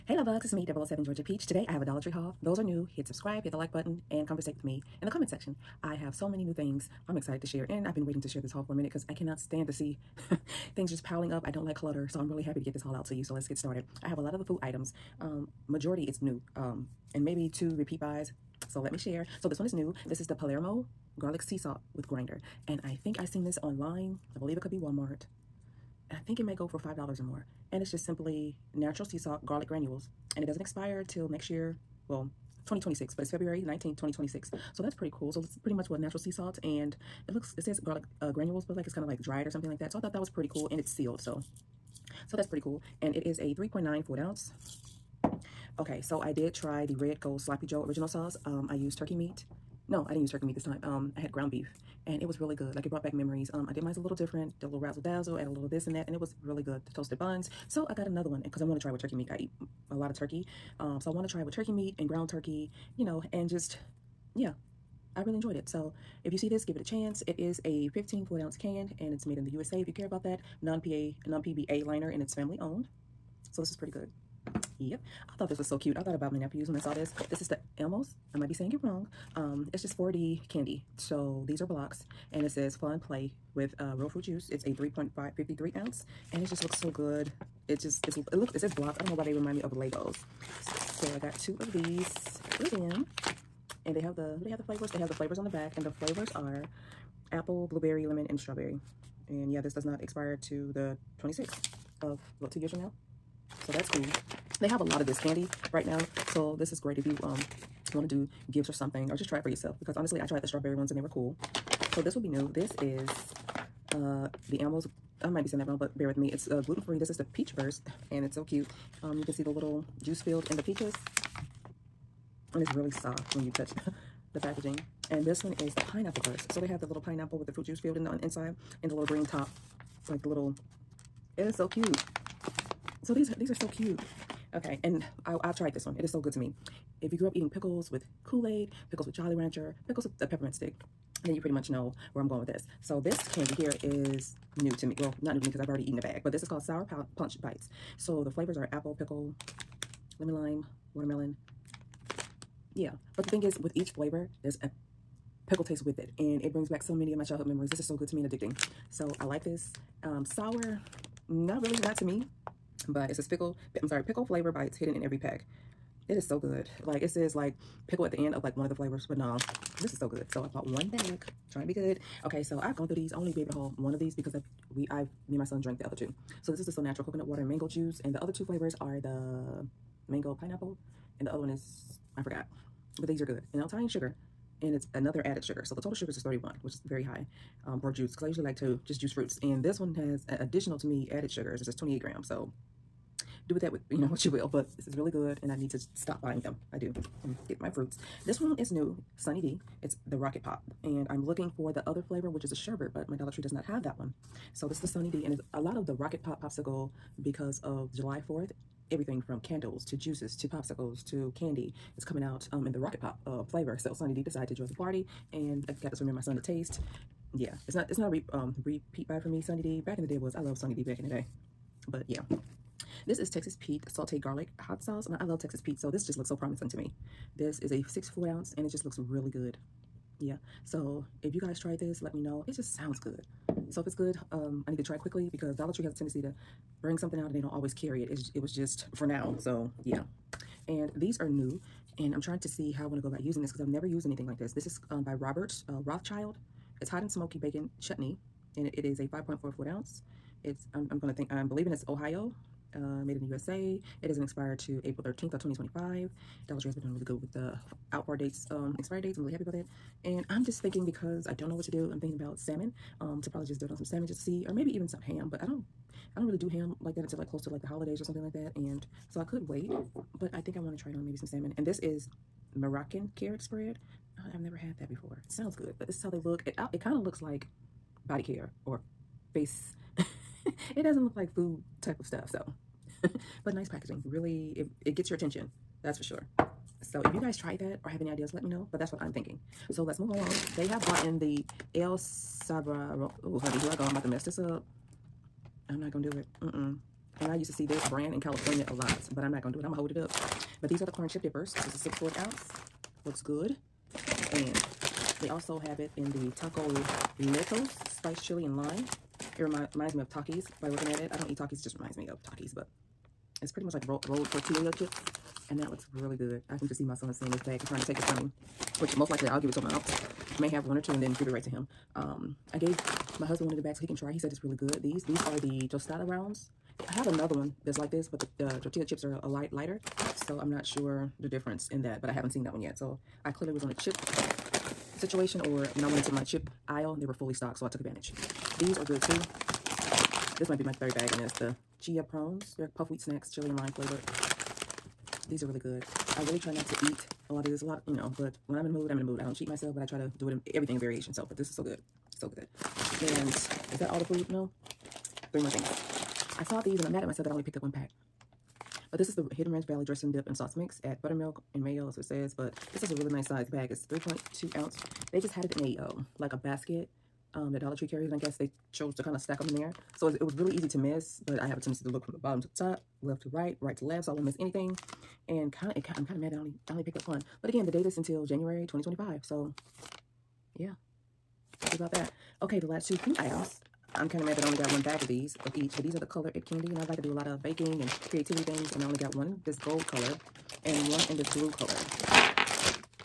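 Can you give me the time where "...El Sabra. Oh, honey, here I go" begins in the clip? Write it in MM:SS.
04:51.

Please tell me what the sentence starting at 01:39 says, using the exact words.
And yeah, this does not expire to the Twenty-six of about two years from now.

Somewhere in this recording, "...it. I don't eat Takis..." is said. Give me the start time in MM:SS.
05:10.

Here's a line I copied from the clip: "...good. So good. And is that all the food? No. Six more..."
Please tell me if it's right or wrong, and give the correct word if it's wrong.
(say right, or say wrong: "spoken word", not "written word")
wrong: "Three", not "Six".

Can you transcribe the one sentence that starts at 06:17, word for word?
But again, the date is until January 2025.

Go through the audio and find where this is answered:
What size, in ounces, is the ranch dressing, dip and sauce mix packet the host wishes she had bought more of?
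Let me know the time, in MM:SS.
06:03.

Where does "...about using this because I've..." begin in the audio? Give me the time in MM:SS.
04:03.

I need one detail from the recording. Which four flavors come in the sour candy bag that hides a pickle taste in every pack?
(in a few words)
apple, pickle, lemon lime, watermelon.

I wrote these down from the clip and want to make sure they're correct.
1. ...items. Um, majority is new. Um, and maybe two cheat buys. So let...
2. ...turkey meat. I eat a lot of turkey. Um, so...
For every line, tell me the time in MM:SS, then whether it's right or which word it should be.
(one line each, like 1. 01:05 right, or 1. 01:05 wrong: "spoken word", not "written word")
1. 00:14 wrong: "repeat", not "cheat"
2. 00:58 right.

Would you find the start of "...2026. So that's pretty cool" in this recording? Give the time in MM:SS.
00:33.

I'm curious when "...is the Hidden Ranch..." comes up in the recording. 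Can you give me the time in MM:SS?
05:59.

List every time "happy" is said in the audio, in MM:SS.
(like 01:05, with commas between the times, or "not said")
00:12, 04:19, 06:21.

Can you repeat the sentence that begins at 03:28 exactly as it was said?
Everything from candles to juices to popsicles to candy is coming out um, in the Rocket Pop uh, flavor.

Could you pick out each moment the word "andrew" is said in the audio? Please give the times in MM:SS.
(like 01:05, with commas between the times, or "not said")
not said.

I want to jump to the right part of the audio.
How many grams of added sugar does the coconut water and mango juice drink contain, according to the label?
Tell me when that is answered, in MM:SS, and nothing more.
03:11.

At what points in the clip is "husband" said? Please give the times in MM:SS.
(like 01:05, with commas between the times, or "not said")
05:23.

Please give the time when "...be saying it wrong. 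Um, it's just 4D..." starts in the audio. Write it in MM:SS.
01:18.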